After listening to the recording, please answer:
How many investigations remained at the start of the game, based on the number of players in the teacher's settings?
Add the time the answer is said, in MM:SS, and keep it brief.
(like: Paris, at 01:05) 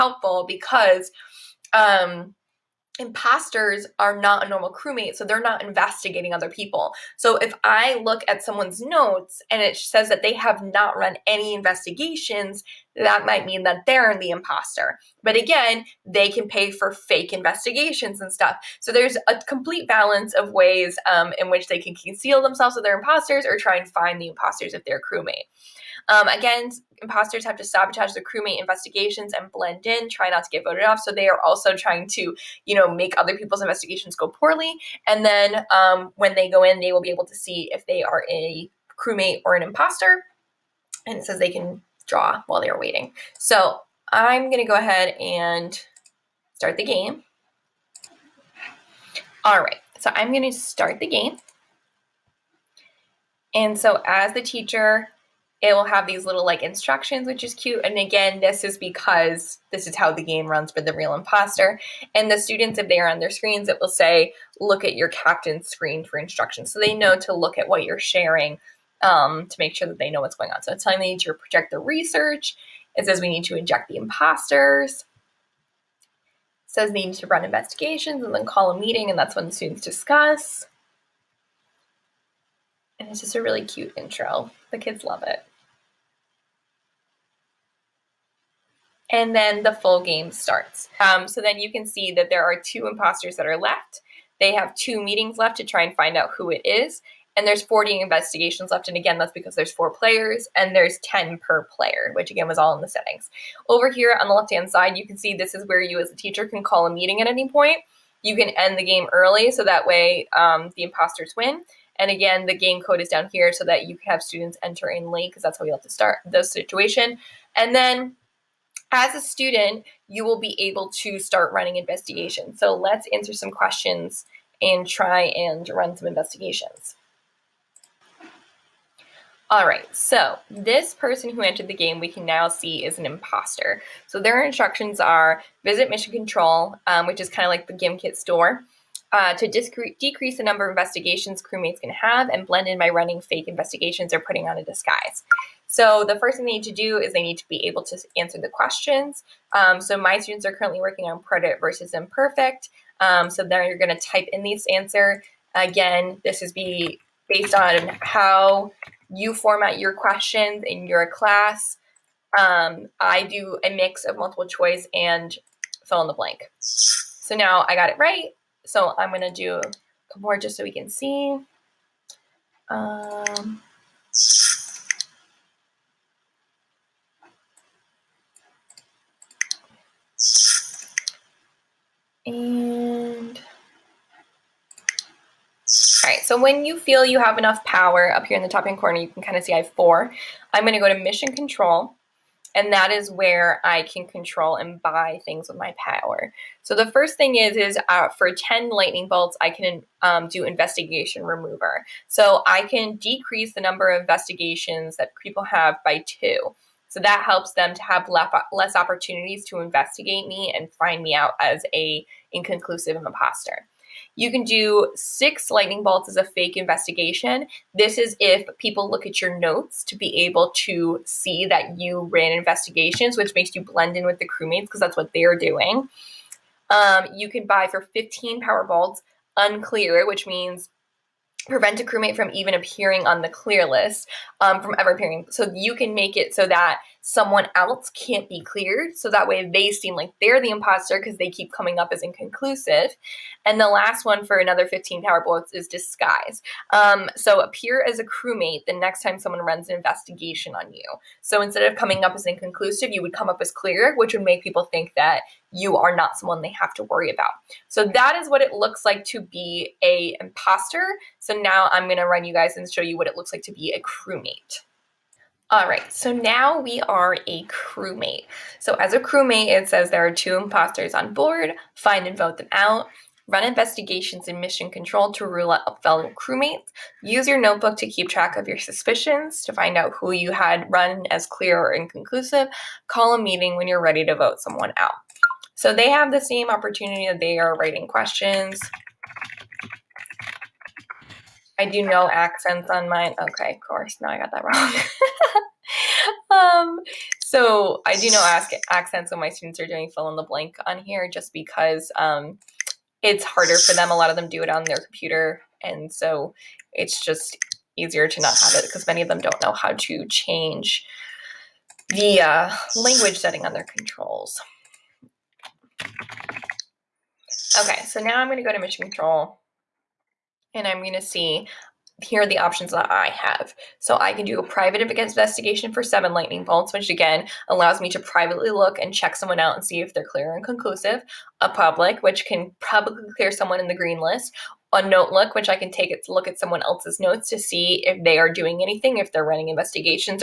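40, at 01:37.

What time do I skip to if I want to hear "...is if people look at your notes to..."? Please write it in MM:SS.
03:37.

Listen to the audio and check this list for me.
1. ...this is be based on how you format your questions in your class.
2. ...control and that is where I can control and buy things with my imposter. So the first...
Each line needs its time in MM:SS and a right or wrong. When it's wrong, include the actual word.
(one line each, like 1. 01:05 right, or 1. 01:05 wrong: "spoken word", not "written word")
1. 02:36 right
2. 03:11 wrong: "power", not "imposter".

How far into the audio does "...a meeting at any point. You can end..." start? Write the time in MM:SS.
01:46.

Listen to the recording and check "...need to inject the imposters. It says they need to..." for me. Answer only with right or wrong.
right.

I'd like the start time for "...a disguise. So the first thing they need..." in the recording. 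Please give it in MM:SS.
02:24.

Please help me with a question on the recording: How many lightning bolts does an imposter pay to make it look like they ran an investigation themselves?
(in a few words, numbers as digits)
6.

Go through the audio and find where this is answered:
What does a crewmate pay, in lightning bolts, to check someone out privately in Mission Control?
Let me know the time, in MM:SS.
05:25.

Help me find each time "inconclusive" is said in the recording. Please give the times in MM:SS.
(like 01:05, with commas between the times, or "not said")
03:32, 04:02, 04:12, 04:41.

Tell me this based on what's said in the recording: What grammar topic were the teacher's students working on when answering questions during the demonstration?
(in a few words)
preterite versus imperfect.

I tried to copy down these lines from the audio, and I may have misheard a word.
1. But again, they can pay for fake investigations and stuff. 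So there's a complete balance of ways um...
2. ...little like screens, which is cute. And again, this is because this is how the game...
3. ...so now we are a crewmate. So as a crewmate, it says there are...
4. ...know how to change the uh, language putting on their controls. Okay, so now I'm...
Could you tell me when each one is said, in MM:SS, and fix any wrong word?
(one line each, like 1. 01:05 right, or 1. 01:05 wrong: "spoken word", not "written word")
1. 00:15 right
2. 00:56 wrong: "instructions", not "screens"
3. 04:25 right
4. 05:09 wrong: "setting", not "putting".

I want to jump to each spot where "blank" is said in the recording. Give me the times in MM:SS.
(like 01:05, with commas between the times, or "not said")
02:46, 05:00.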